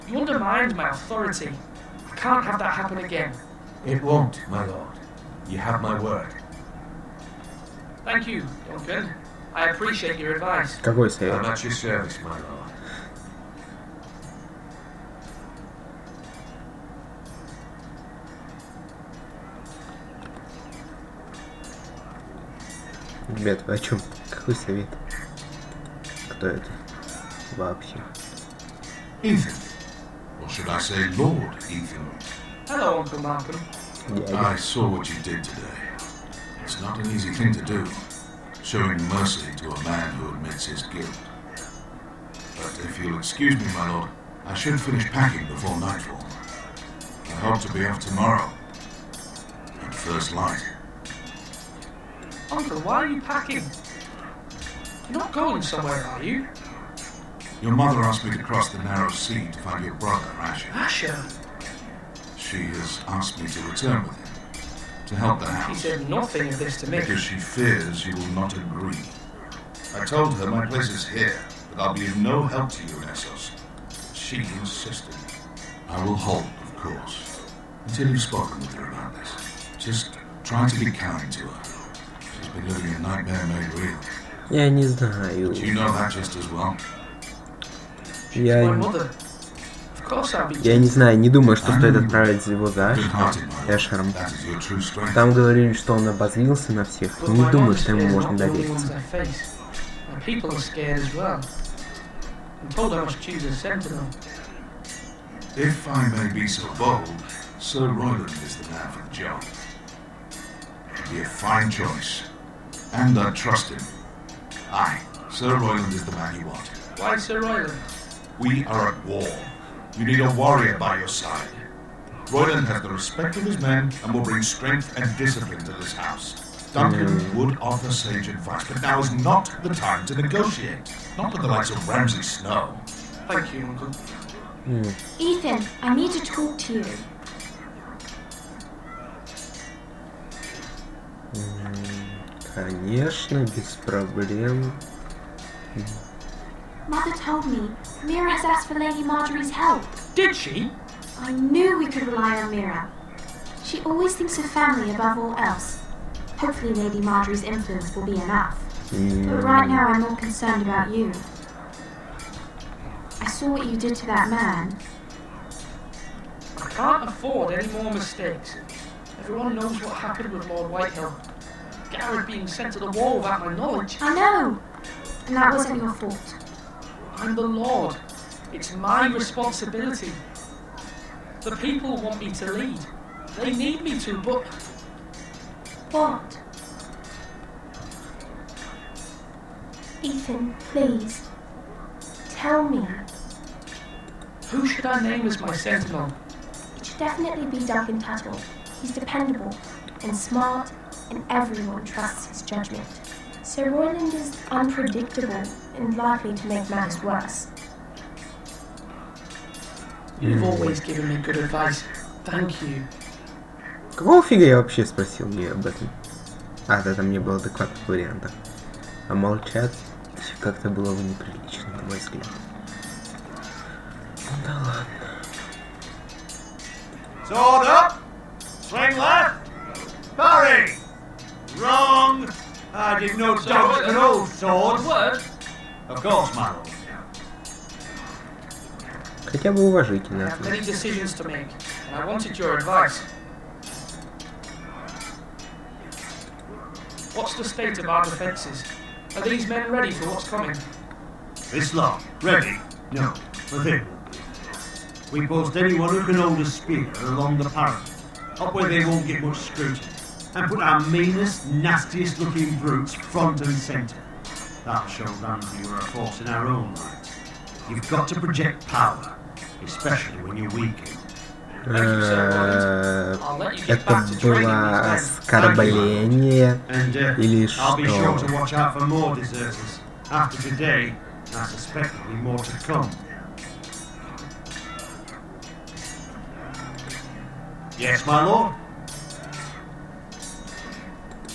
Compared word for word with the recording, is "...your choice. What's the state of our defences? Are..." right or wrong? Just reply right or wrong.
wrong.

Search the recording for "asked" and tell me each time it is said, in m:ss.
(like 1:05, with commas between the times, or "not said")
0:58, 1:03, 2:28.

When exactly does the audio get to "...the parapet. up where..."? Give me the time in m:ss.
4:17.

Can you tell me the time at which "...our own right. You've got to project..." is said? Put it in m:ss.
4:26.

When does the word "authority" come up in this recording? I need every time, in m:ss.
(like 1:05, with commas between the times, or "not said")
0:00.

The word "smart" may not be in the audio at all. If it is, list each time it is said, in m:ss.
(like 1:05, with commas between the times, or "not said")
3:20.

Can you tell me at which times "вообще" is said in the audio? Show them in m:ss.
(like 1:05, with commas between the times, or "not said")
0:27, 3:34.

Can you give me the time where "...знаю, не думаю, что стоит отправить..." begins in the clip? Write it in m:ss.
1:30.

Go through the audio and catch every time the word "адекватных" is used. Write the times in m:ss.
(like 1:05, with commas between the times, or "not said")
3:37.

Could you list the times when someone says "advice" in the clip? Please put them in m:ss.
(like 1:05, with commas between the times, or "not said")
0:10, 2:08, 3:31, 4:02.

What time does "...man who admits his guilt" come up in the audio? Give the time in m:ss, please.
0:39.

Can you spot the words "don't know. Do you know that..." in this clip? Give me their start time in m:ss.
1:24.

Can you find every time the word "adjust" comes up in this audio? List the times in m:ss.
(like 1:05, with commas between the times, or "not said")
not said.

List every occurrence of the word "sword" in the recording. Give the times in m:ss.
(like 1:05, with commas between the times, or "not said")
3:47, 3:54.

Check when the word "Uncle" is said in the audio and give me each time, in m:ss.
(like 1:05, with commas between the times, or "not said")
0:32, 0:52, 2:13.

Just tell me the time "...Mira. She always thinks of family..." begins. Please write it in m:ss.
2:32.